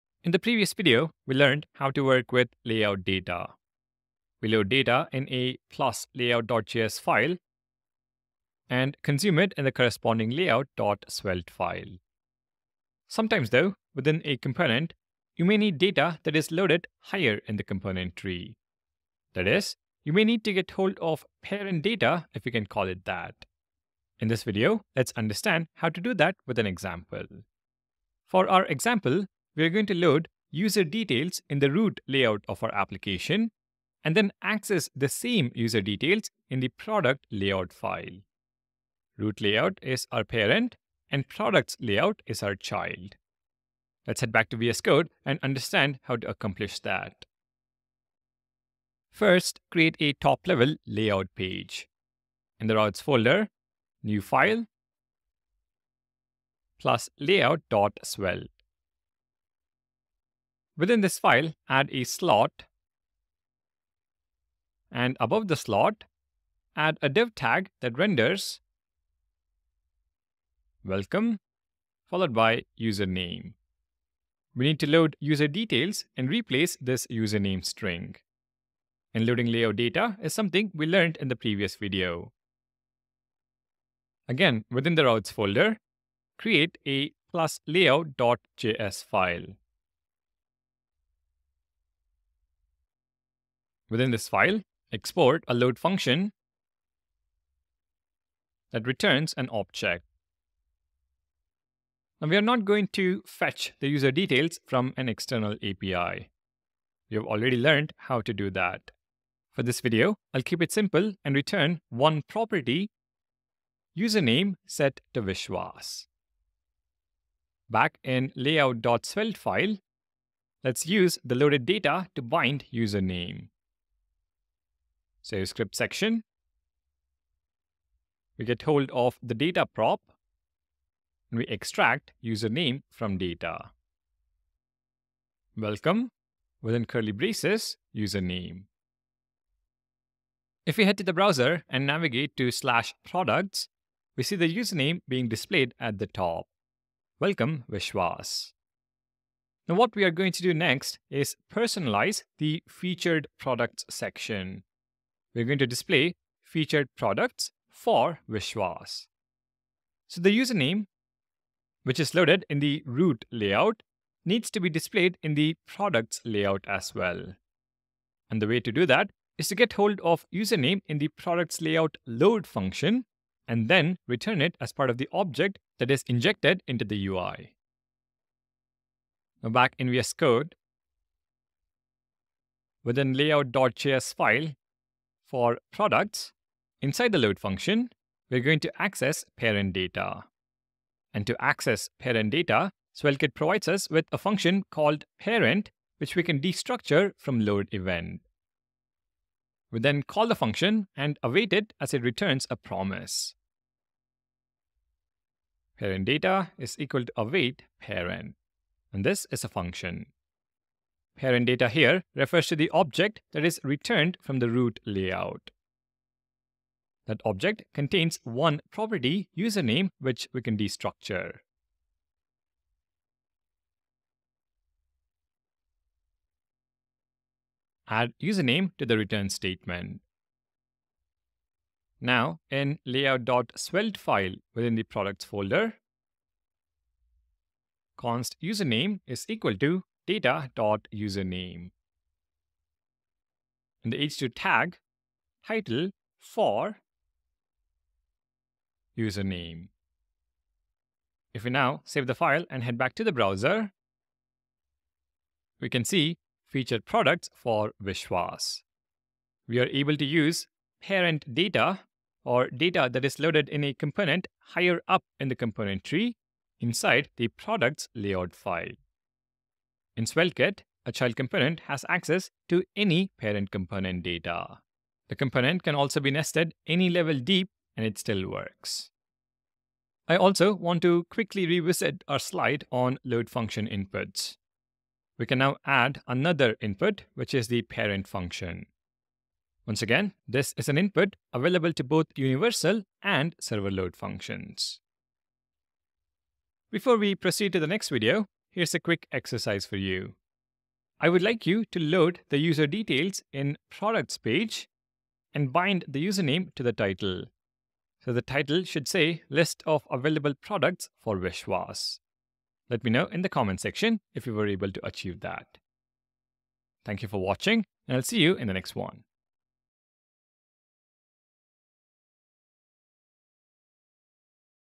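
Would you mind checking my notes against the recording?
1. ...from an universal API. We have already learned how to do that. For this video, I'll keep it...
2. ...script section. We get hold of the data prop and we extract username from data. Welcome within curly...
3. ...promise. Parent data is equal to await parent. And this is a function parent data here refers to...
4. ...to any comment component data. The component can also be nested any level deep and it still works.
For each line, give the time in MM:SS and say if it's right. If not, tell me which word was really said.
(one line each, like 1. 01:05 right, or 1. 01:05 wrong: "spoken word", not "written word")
1. 01:44 wrong: "external", not "universal"
2. 02:05 right
3. 03:22 right
4. 04:32 wrong: "parent", not "comment".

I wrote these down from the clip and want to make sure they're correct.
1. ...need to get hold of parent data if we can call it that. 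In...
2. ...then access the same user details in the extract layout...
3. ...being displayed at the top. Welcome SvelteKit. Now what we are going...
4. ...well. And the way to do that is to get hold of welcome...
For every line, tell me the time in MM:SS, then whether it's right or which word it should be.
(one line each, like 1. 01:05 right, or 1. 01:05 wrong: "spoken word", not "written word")
1. 00:20 right
2. 00:34 wrong: "product", not "extract"
3. 02:25 wrong: "Vishwas", not "SvelteKit"
4. 02:46 wrong: "username", not "welcome".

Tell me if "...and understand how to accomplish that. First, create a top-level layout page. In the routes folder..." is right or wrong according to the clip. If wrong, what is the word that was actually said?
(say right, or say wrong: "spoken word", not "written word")
right.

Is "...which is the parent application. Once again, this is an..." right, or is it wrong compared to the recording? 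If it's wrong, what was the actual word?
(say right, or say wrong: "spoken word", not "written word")
wrong: "function", not "application".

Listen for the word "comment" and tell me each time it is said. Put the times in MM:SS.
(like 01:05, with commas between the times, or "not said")
05:13.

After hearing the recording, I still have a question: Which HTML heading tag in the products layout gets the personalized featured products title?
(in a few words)
h2.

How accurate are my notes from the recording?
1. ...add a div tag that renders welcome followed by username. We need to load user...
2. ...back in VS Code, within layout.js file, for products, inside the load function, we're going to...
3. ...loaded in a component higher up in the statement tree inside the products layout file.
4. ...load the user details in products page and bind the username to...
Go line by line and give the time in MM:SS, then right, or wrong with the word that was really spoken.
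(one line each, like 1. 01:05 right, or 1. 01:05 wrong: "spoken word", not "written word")
1. 01:06 right
2. 02:59 right
3. 04:23 wrong: "component", not "statement"
4. 05:01 right.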